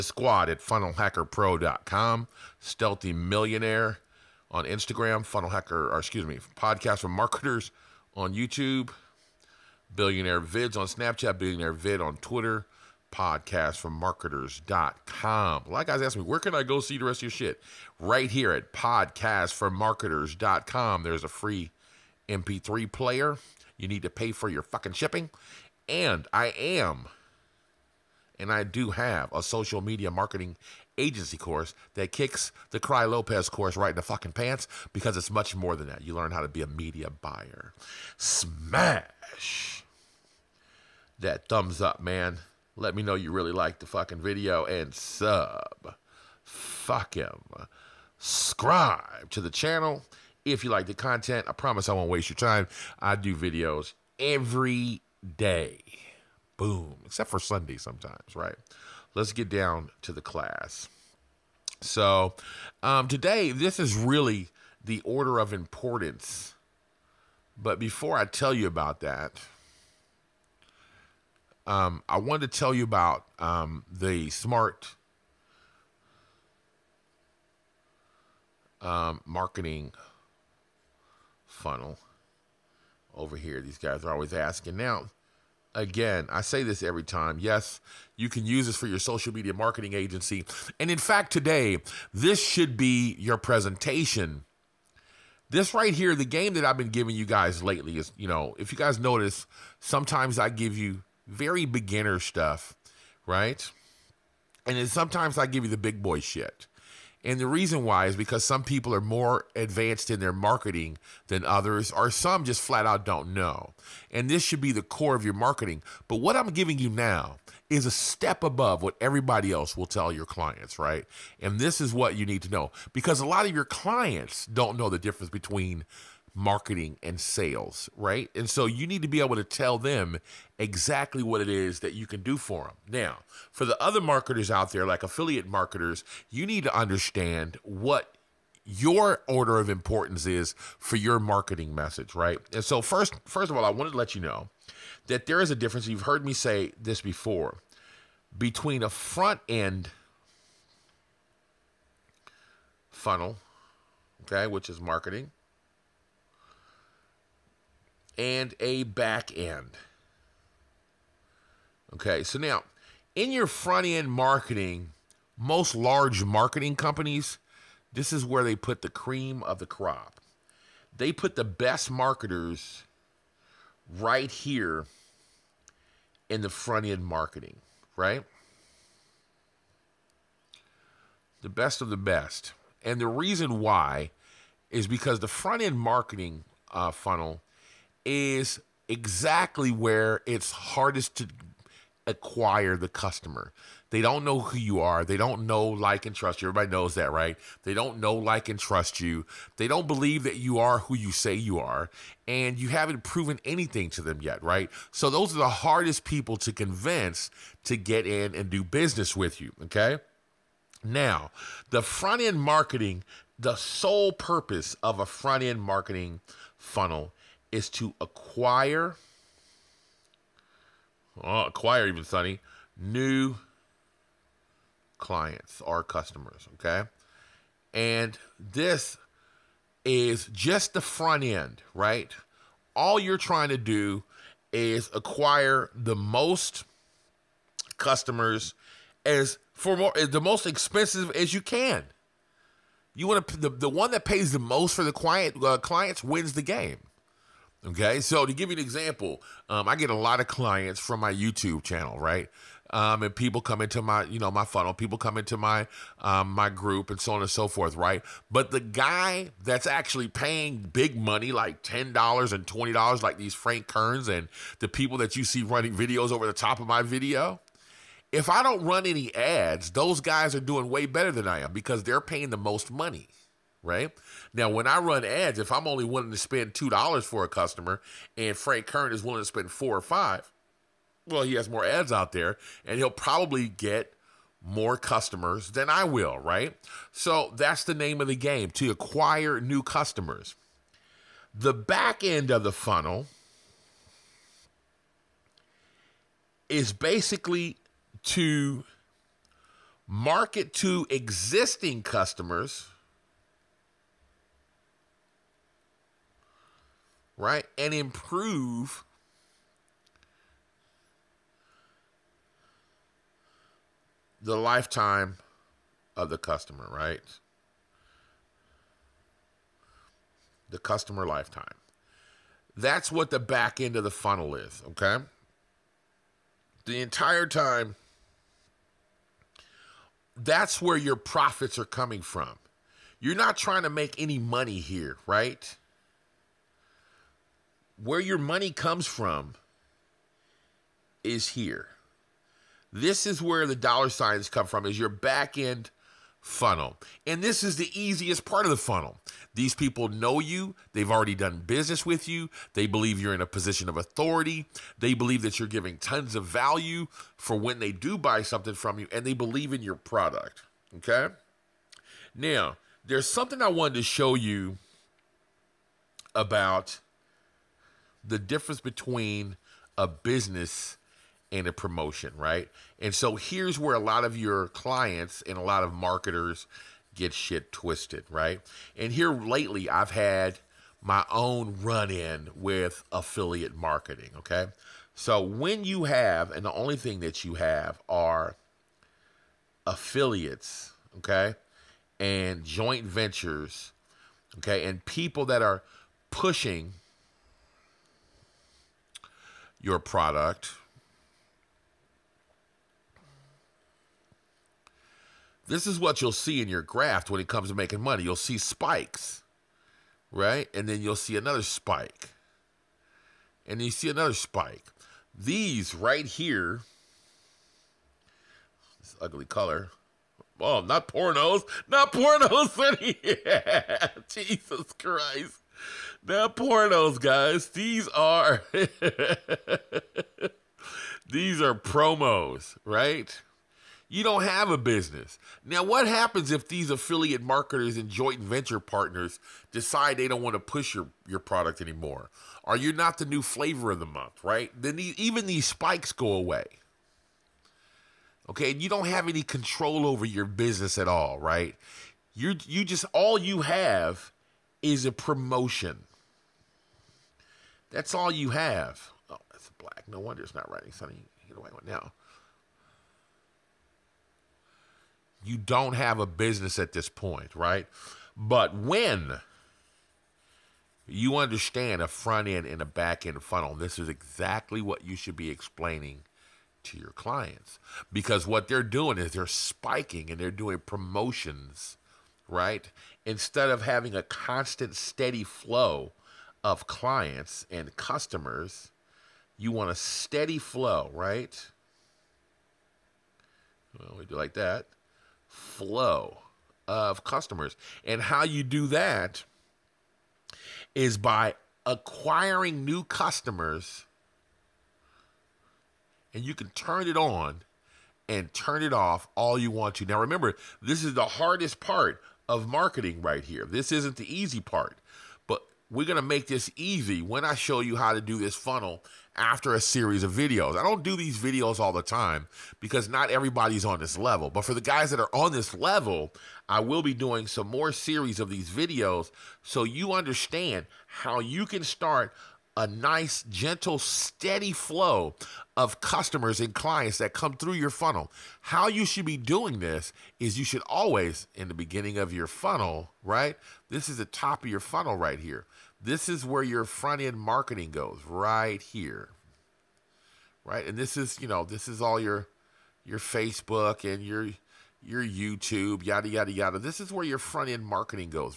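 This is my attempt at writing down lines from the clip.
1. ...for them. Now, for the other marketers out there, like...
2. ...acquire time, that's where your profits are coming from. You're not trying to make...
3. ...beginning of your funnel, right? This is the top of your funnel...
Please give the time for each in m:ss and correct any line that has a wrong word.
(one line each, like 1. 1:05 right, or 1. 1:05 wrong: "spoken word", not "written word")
1. 2:12 right
2. 5:26 wrong: "entire", not "acquire"
3. 9:01 right.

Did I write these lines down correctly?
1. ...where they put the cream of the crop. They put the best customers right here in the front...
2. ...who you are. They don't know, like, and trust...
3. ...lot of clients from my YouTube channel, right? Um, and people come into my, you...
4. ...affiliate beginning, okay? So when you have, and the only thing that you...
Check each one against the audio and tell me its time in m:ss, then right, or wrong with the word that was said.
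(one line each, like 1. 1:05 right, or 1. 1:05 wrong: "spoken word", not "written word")
1. 2:48 wrong: "marketers", not "customers"
2. 3:14 right
3. 4:09 right
4. 6:22 wrong: "marketing", not "beginning".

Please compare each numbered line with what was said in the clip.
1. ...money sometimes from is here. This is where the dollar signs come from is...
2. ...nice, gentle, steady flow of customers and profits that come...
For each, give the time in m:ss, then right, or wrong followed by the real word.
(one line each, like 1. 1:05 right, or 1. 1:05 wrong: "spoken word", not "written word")
1. 5:38 wrong: "comes", not "sometimes"
2. 8:52 wrong: "clients", not "profits".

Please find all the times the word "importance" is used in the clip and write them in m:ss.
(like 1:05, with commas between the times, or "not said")
1:05, 2:19.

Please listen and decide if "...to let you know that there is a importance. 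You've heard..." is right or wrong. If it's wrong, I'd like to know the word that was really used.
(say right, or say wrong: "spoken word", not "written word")
wrong: "difference", not "importance".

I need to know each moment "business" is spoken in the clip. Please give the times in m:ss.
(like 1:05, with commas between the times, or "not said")
3:28, 5:51, 6:09, 7:14, 7:30, 7:46.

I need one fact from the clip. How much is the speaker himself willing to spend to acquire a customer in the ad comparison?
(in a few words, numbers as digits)
$2.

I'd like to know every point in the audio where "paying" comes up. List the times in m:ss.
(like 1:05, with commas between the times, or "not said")
4:20, 4:32.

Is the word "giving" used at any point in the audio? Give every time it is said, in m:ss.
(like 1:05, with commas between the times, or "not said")
1:36, 1:56, 5:55.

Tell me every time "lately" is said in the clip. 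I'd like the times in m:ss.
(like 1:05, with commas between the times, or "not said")
1:37, 6:19.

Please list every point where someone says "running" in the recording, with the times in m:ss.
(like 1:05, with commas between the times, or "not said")
4:25.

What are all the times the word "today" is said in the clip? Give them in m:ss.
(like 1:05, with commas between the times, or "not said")
1:03, 1:31.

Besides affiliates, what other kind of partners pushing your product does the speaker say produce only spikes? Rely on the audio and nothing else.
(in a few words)
joint ventures.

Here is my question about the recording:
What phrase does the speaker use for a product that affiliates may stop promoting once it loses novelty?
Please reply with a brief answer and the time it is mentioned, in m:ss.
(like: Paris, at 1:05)
flavor of the month, at 7:23.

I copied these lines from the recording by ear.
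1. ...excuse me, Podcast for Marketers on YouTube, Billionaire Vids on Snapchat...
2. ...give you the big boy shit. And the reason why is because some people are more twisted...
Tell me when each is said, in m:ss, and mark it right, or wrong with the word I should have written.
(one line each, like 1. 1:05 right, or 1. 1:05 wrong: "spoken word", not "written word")
1. 0:05 right
2. 1:45 wrong: "advanced", not "twisted".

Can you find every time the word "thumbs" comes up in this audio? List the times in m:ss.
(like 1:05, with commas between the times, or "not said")
0:41.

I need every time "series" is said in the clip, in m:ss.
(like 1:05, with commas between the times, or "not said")
8:39, 8:47.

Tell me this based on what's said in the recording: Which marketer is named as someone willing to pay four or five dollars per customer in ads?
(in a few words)
Frank Kern.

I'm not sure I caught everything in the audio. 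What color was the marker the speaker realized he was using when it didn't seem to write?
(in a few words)
black.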